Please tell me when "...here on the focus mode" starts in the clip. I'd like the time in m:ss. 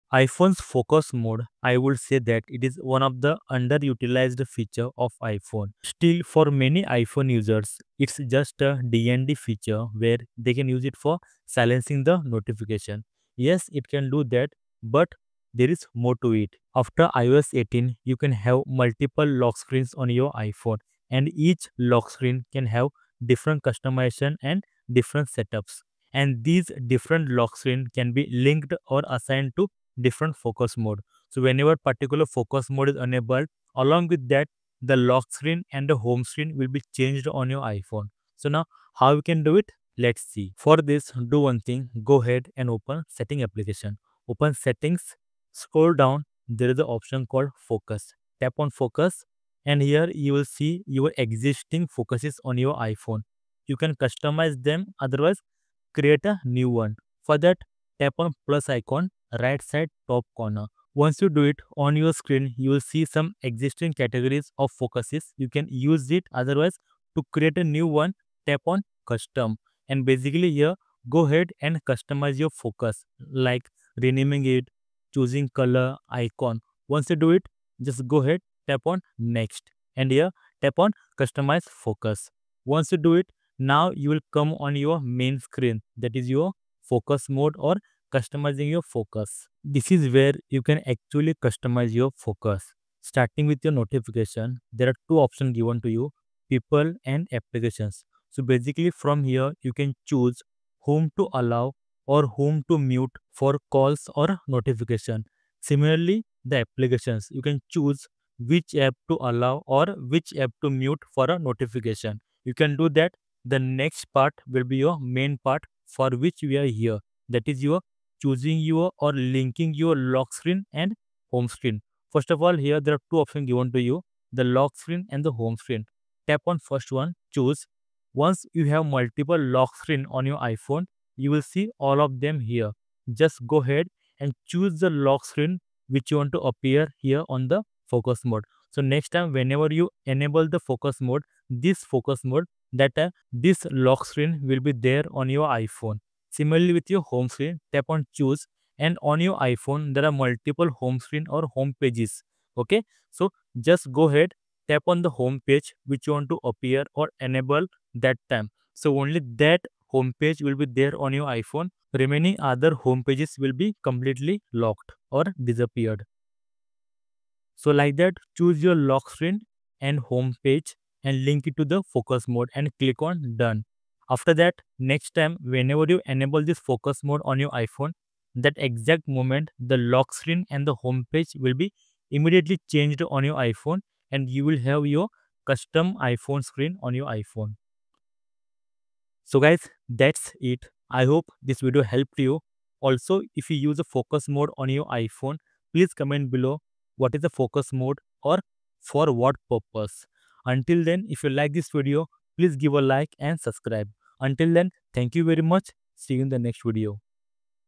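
2:16.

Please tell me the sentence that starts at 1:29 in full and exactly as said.
This is where you can actually customize your focus.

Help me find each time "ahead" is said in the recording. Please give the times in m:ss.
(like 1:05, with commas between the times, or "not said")
0:42, 1:11, 1:18, 2:13, 2:34.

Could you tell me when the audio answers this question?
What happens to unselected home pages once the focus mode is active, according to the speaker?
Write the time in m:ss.
2:44.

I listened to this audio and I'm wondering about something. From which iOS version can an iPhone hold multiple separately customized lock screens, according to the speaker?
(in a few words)
iOS 18.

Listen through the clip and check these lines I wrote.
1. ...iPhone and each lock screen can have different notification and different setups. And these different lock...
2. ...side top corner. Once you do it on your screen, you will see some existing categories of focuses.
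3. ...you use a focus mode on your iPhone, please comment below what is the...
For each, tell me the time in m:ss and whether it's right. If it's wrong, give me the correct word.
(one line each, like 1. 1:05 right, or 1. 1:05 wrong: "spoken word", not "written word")
1. 0:20 wrong: "customization", not "notification"
2. 0:59 right
3. 3:13 right.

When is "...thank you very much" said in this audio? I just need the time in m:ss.
3:24.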